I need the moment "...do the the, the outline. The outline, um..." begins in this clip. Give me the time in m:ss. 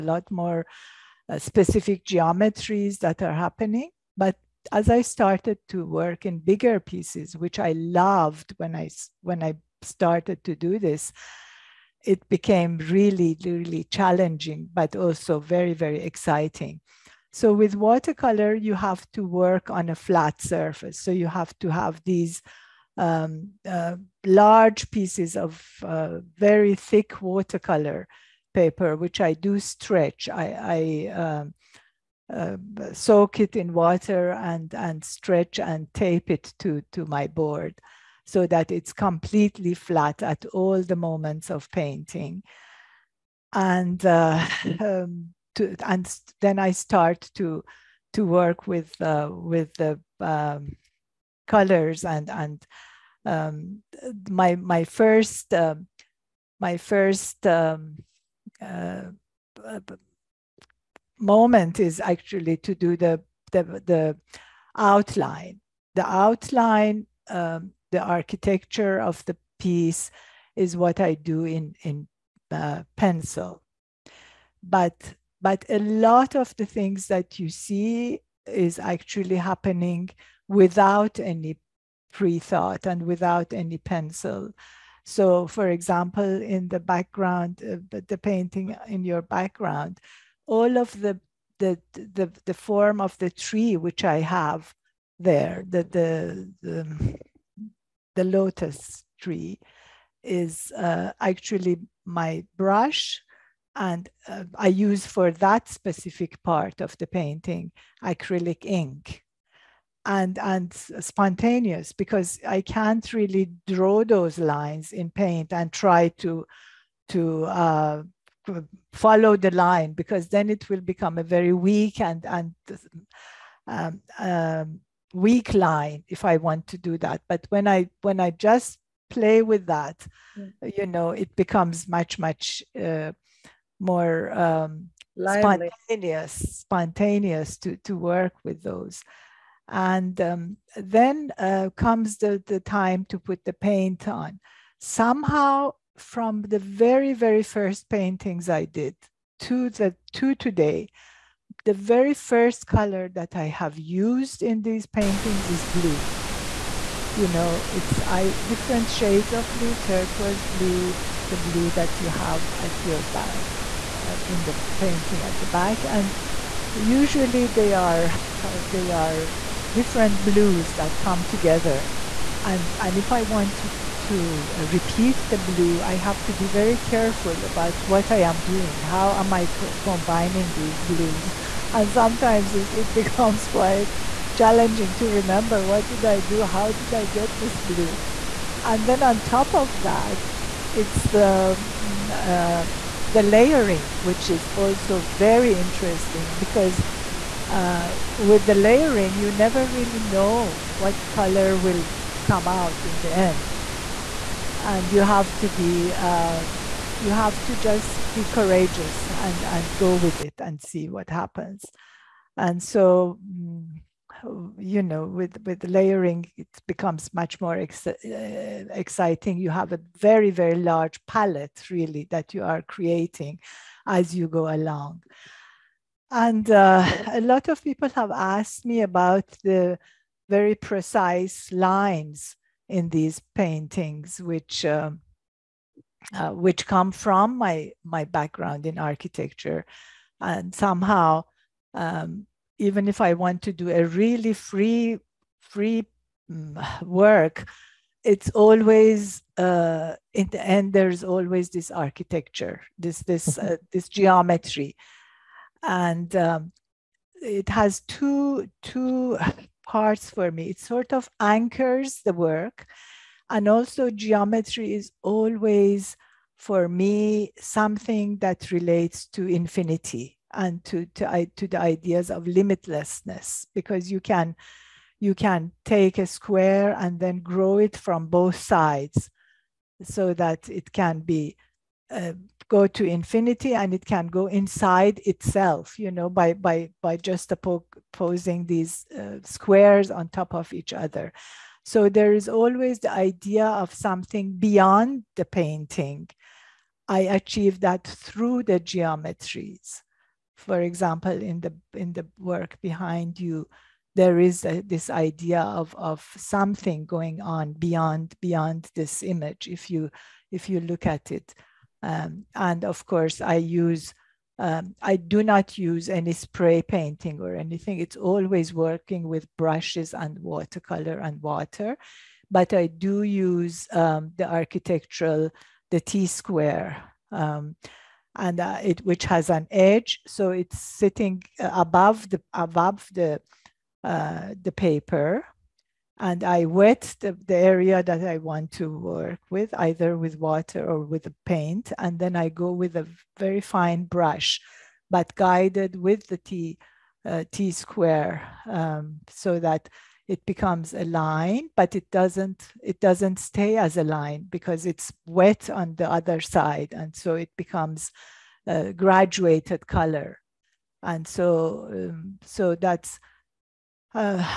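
1:02.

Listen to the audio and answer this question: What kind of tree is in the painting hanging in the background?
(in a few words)
Lotus tree.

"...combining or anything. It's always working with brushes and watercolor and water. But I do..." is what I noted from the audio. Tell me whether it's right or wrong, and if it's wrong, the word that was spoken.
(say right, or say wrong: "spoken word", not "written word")
wrong: "painting", not "combining".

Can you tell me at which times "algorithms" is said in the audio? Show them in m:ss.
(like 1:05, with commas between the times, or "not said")
not said.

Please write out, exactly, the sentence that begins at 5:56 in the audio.
And so it becomes a graduated color.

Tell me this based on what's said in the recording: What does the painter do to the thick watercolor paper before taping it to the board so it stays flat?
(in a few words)
Soak it in water.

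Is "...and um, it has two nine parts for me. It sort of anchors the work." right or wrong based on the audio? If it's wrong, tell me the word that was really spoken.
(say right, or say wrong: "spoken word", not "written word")
wrong: "two", not "nine".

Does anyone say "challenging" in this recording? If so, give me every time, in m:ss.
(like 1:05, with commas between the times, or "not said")
0:13, 3:04.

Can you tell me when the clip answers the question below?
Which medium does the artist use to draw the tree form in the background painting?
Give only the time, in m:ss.
1:48.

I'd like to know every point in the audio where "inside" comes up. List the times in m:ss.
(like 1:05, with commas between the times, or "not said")
4:44.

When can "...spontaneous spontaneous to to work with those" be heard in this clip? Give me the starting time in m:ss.
2:15.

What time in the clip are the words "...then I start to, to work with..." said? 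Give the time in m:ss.
0:46.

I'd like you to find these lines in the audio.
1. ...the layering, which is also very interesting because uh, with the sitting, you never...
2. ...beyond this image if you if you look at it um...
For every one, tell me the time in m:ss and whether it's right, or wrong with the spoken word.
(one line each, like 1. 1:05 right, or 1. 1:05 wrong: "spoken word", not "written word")
1. 3:13 wrong: "layering", not "sitting"
2. 5:08 right.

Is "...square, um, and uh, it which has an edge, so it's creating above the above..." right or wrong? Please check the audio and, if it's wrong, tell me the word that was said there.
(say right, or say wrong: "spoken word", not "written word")
wrong: "sitting", not "creating".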